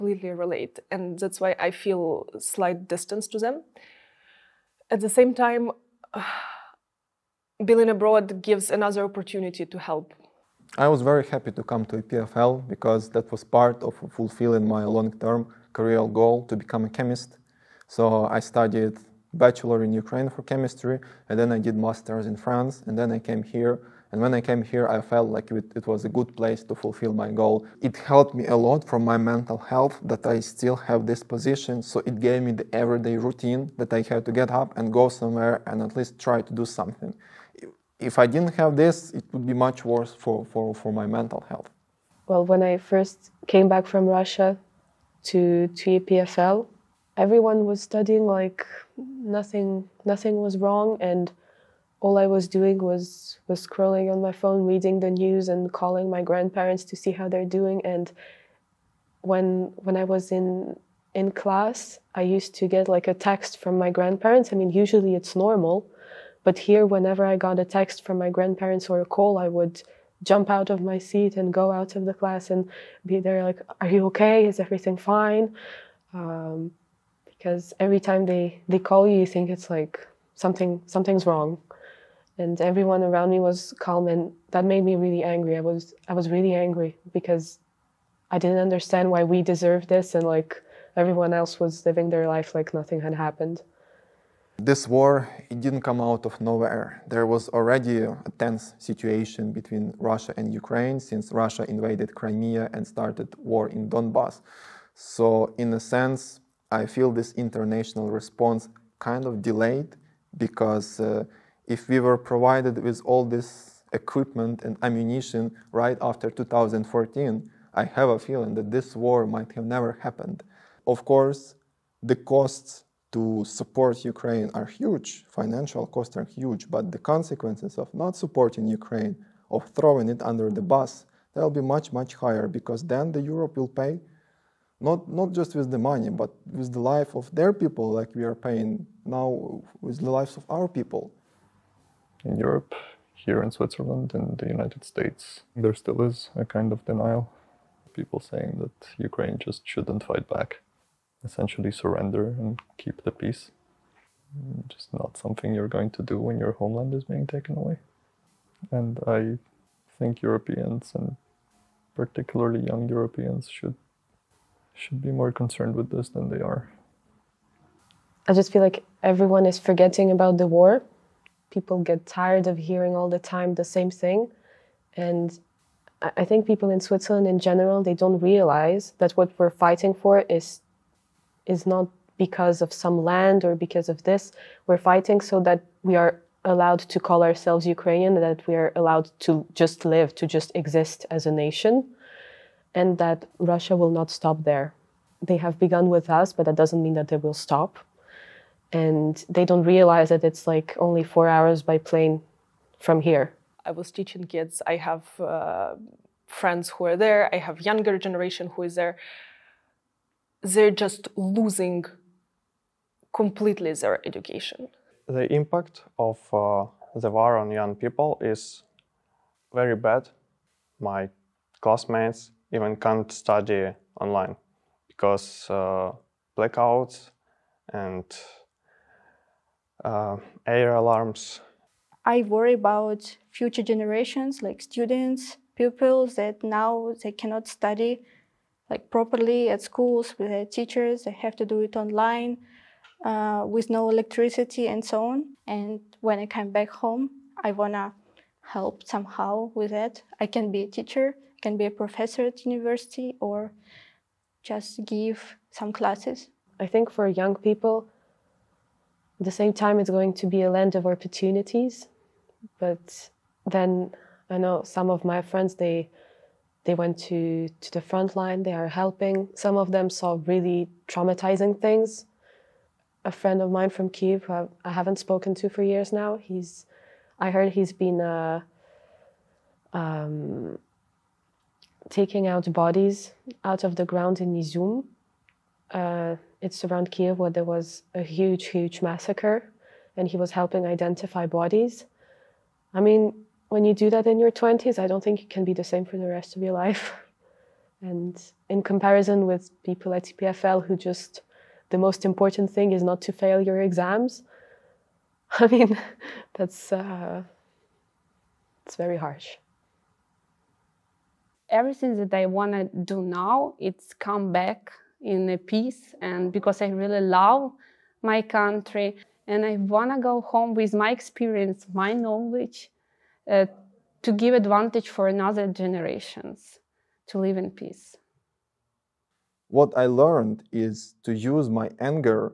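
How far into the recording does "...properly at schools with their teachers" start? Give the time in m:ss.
3:58.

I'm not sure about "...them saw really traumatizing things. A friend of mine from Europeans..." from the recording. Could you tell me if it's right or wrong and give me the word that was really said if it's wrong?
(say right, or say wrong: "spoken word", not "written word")
wrong: "Kiev", not "Europeans".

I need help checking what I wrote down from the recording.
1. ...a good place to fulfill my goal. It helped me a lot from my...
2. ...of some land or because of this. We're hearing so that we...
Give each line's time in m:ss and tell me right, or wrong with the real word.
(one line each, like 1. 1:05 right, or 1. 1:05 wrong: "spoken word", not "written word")
1. 0:26 right
2. 3:02 wrong: "fighting", not "hearing".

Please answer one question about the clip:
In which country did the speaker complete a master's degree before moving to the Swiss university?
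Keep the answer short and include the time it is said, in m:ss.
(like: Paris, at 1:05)
France, at 0:22.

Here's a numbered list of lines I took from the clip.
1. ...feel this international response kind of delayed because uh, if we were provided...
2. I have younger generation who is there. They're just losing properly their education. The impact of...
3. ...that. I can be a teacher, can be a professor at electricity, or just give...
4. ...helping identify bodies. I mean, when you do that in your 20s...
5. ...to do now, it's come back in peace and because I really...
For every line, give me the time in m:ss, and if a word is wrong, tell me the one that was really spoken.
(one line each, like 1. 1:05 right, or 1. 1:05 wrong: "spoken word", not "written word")
1. 1:46 right
2. 3:27 wrong: "completely", not "properly"
3. 4:09 wrong: "university", not "electricity"
4. 4:50 right
5. 5:12 right.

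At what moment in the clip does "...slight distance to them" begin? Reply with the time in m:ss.
0:02.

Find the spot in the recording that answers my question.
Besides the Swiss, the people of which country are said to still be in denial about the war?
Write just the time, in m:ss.
2:24.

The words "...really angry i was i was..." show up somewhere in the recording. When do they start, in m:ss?
1:25.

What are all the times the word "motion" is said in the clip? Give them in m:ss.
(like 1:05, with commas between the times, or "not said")
not said.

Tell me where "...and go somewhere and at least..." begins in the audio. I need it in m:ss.
0:34.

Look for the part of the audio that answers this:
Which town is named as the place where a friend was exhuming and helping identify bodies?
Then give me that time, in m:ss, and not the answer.
4:44.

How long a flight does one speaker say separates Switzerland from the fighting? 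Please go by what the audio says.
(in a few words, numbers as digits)
4 hours.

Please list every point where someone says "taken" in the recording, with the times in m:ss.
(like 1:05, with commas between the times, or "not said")
2:37.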